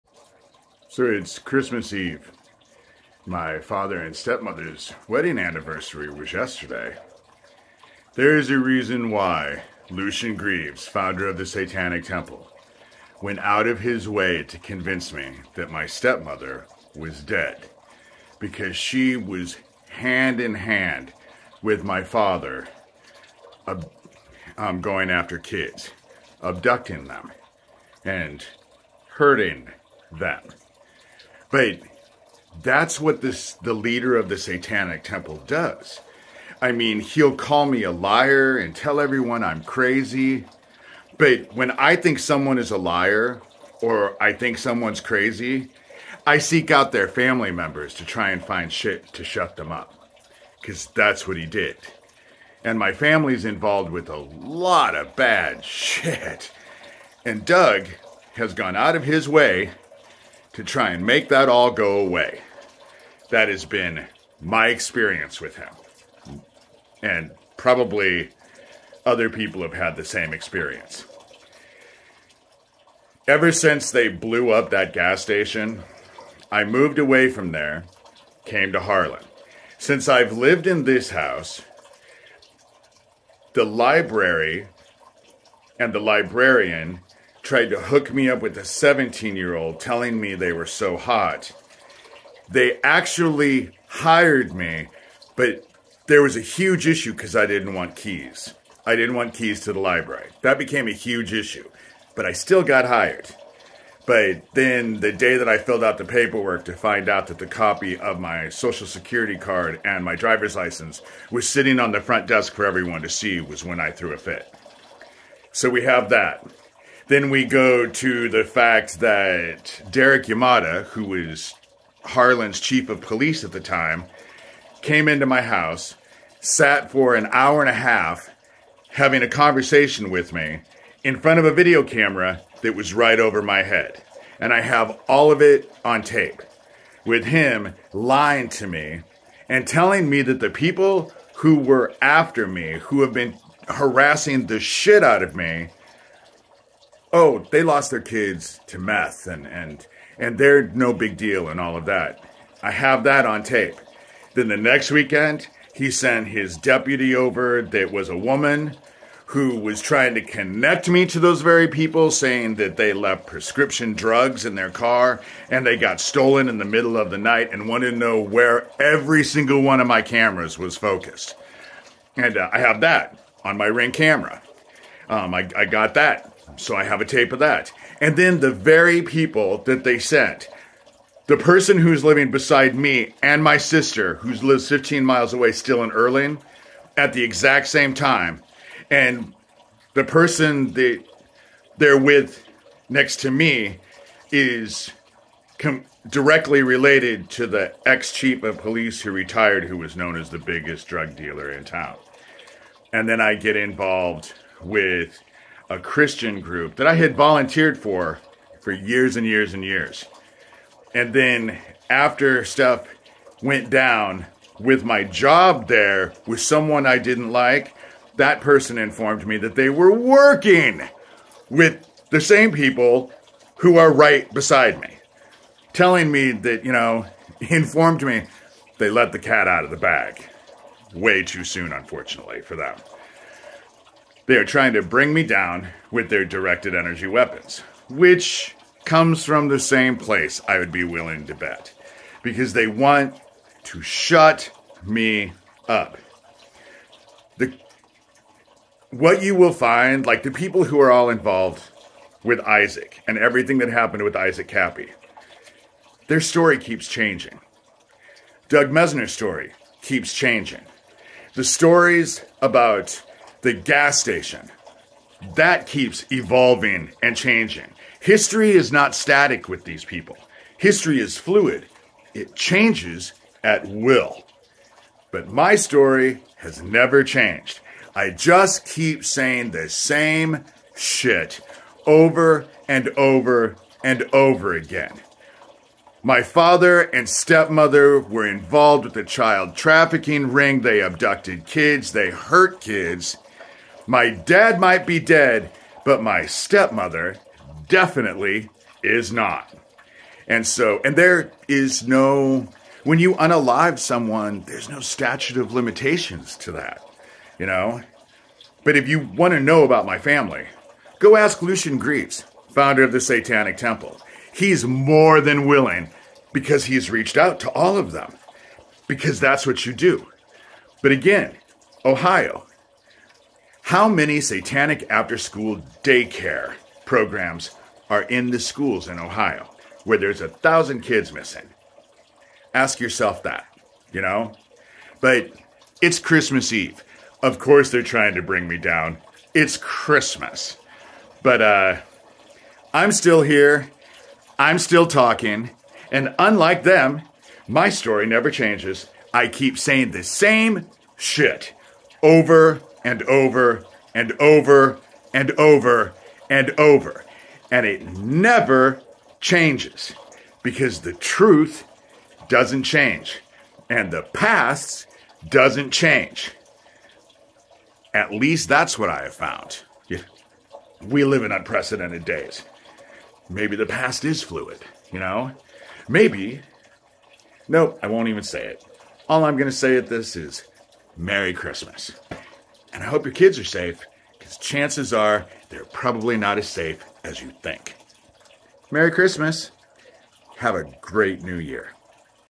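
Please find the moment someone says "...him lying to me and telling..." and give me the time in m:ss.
2:17.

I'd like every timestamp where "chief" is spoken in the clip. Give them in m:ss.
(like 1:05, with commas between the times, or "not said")
2:02, 3:18.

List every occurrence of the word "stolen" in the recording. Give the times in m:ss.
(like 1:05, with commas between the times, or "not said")
2:46.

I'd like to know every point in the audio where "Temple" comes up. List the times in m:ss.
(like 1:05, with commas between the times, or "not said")
0:12, 0:35, 5:13.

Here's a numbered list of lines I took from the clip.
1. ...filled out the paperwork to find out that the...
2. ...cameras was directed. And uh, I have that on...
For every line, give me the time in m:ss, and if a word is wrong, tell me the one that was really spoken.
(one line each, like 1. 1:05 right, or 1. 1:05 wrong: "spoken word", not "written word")
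1. 1:45 right
2. 2:50 wrong: "focused", not "directed".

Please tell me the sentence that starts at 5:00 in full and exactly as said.
And so, and there is no, when you unalive someone, there's no statute of limitations to that, you know?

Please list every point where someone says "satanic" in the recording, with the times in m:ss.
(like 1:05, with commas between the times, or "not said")
0:11, 0:34, 5:13, 5:24.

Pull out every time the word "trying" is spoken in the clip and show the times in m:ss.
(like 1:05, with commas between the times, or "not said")
2:39, 3:54, 5:37.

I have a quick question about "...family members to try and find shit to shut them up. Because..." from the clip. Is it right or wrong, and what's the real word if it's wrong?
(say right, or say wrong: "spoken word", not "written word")
right.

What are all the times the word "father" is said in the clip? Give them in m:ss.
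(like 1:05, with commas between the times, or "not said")
0:03, 0:22, 4:46.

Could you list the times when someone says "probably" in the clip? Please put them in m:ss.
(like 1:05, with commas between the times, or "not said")
1:07, 6:25.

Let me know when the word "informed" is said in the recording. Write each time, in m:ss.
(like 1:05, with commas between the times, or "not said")
3:38, 3:47.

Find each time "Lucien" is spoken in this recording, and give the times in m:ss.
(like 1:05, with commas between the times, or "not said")
0:09, 5:11.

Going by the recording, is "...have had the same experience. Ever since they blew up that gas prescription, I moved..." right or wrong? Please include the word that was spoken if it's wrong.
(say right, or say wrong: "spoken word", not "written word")
wrong: "station", not "prescription".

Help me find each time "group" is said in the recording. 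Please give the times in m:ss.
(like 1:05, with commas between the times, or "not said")
3:26.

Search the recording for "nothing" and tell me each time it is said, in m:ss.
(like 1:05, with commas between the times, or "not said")
not said.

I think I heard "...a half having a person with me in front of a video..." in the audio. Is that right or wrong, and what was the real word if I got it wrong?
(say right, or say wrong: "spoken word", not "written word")
wrong: "conversation", not "person".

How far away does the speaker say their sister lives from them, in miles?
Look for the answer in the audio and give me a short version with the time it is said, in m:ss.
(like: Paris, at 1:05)
15 miles, at 3:04.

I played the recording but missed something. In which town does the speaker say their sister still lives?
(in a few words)
Erling.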